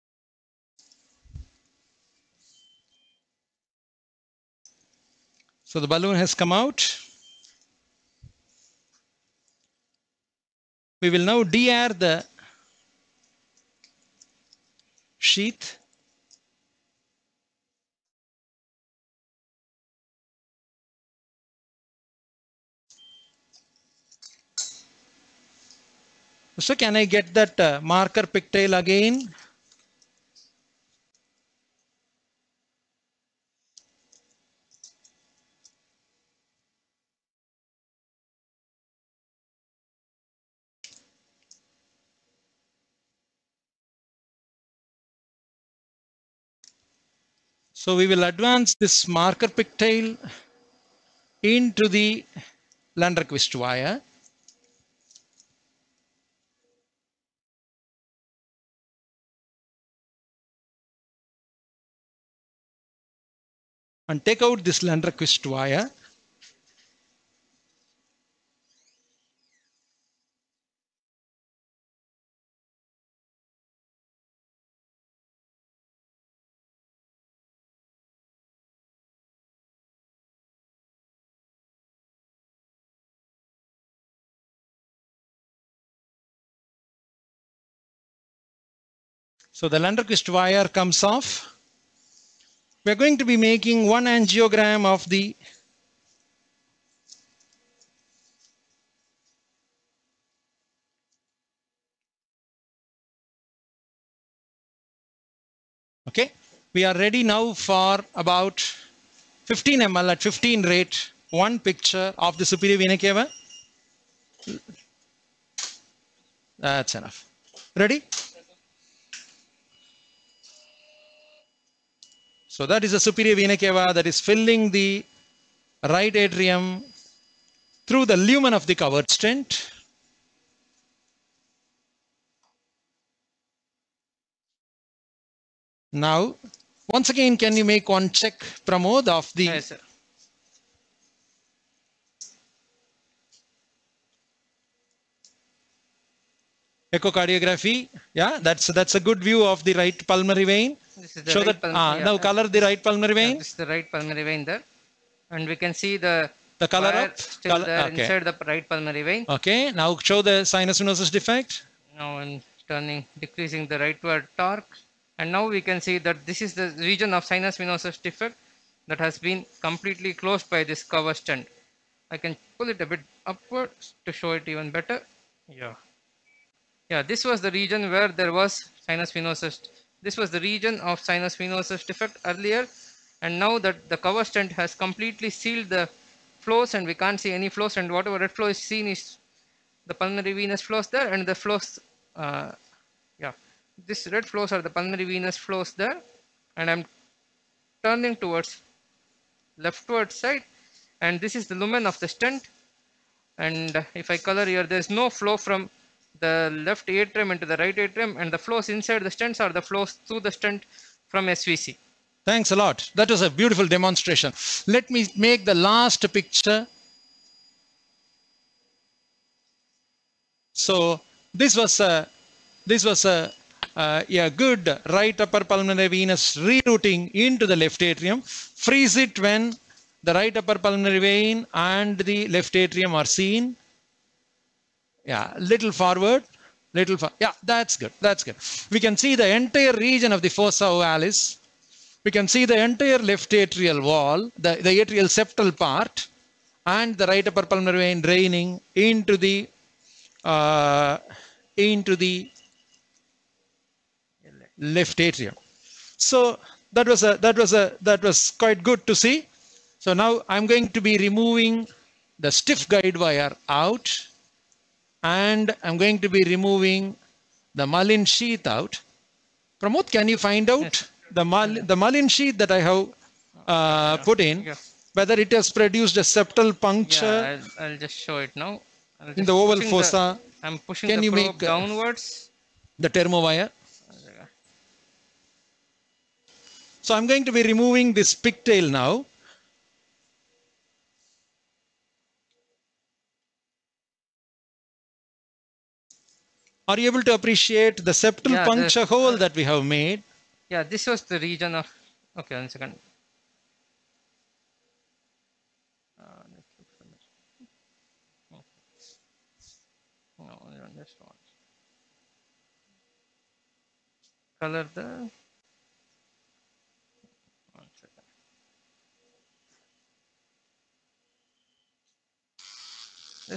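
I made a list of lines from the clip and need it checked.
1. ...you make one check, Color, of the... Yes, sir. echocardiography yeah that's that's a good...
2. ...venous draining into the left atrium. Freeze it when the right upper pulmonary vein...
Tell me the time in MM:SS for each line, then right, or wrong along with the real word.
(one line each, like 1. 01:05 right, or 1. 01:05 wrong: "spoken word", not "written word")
1. 02:17 wrong: "Pramod", not "Color"
2. 03:45 wrong: "rerouting", not "draining".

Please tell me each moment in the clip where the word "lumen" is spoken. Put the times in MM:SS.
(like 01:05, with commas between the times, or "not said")
02:08, 03:21.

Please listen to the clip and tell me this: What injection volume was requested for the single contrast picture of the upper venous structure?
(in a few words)
15 ml.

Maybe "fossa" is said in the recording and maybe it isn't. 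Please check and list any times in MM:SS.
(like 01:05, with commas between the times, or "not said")
04:00, 04:39.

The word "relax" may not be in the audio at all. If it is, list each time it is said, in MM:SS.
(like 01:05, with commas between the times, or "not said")
not said.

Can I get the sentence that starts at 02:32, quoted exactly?
now color the right pulmonary vein.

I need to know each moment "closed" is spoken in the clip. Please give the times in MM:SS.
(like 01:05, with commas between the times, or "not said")
02:50.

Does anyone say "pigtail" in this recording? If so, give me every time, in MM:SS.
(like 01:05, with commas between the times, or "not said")
00:28, 00:49, 04:48.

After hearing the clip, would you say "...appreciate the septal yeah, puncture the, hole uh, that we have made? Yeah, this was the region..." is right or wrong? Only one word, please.
right.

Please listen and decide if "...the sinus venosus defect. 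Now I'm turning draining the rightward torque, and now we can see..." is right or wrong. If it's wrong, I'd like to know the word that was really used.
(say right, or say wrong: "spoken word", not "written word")
wrong: "decreasing", not "draining".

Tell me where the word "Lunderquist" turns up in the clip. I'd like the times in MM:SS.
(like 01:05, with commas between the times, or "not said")
00:52, 01:04, 01:29.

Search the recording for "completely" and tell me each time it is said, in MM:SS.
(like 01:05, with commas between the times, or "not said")
02:49, 03:04.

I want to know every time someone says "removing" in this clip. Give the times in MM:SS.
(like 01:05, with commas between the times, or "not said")
04:20, 04:26, 04:47.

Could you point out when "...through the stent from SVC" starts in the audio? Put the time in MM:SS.
03:30.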